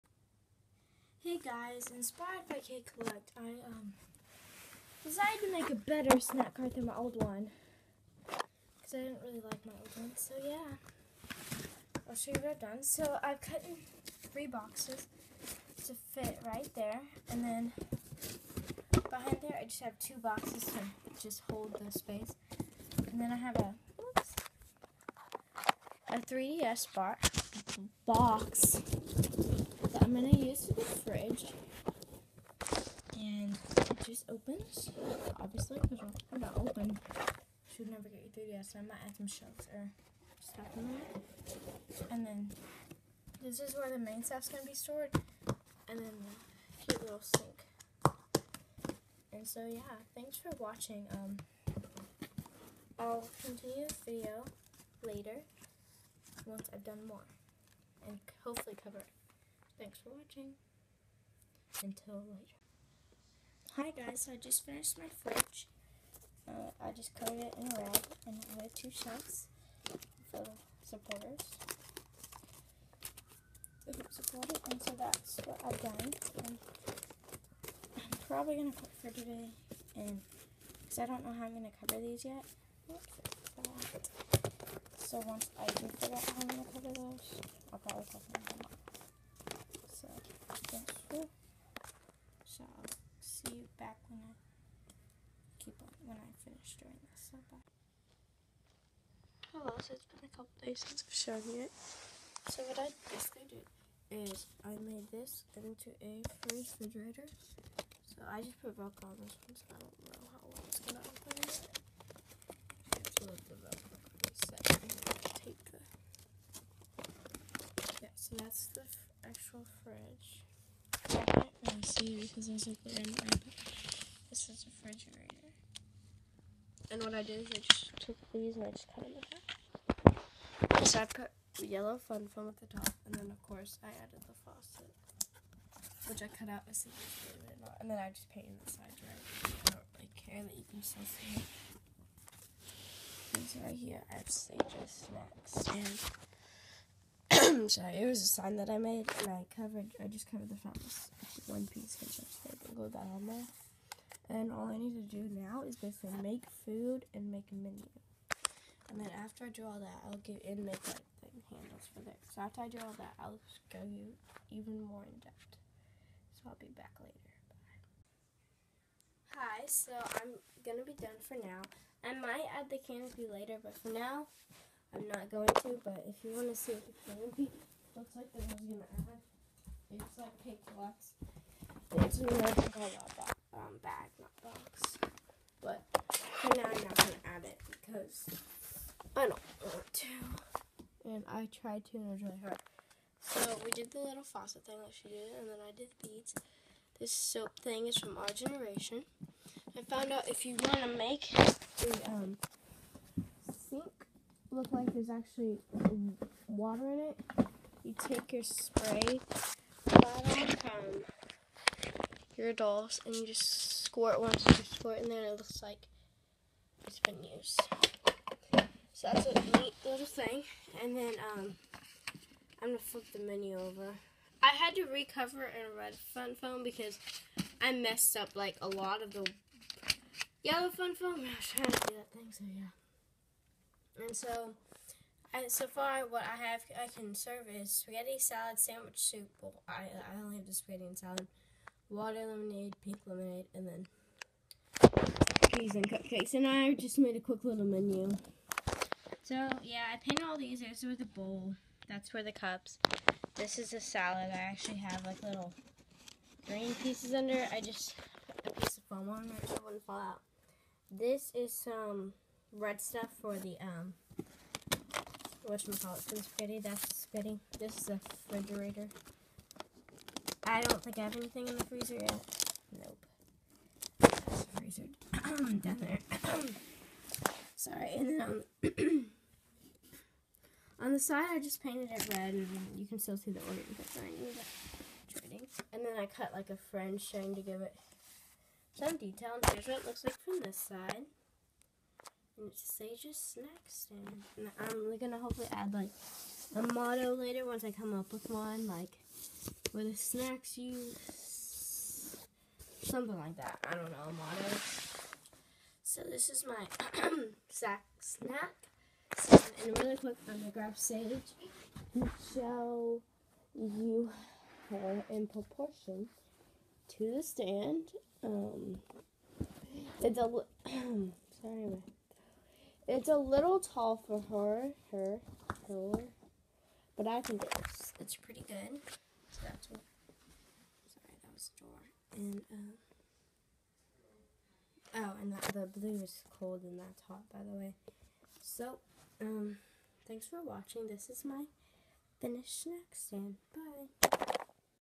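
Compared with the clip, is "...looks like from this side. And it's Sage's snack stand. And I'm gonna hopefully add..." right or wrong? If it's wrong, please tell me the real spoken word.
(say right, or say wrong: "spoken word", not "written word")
right.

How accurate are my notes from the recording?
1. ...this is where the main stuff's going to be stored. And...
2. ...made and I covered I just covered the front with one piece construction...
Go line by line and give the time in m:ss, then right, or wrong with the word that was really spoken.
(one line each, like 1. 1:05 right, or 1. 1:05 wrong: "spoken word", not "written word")
1. 0:43 right
2. 2:28 right.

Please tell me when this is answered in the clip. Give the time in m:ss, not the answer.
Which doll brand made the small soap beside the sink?
3:18.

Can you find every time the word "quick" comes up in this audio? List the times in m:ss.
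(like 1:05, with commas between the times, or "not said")
4:07, 5:09.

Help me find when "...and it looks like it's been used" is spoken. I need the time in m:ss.
3:35.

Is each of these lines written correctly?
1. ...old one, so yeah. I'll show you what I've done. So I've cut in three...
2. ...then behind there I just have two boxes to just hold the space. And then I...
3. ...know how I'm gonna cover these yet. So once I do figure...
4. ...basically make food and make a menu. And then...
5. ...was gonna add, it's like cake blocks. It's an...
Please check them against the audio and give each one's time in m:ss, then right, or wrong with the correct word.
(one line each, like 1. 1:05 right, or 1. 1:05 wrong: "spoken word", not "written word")
1. 0:09 right
2. 0:17 right
3. 1:21 right
4. 2:35 right
5. 2:58 right.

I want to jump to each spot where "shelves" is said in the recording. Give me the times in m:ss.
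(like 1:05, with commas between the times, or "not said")
0:39, 1:08.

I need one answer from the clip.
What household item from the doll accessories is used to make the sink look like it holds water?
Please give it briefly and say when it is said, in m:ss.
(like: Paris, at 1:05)
Spray bottle, at 3:28.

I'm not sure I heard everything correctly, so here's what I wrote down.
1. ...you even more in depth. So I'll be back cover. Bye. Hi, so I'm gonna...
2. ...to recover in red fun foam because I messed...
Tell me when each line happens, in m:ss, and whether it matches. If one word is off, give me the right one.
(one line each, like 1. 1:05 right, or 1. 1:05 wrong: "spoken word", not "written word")
1. 2:43 wrong: "later", not "cover"
2. 3:44 right.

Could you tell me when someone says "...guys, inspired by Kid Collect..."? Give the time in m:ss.
0:01.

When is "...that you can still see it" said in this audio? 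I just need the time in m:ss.
2:20.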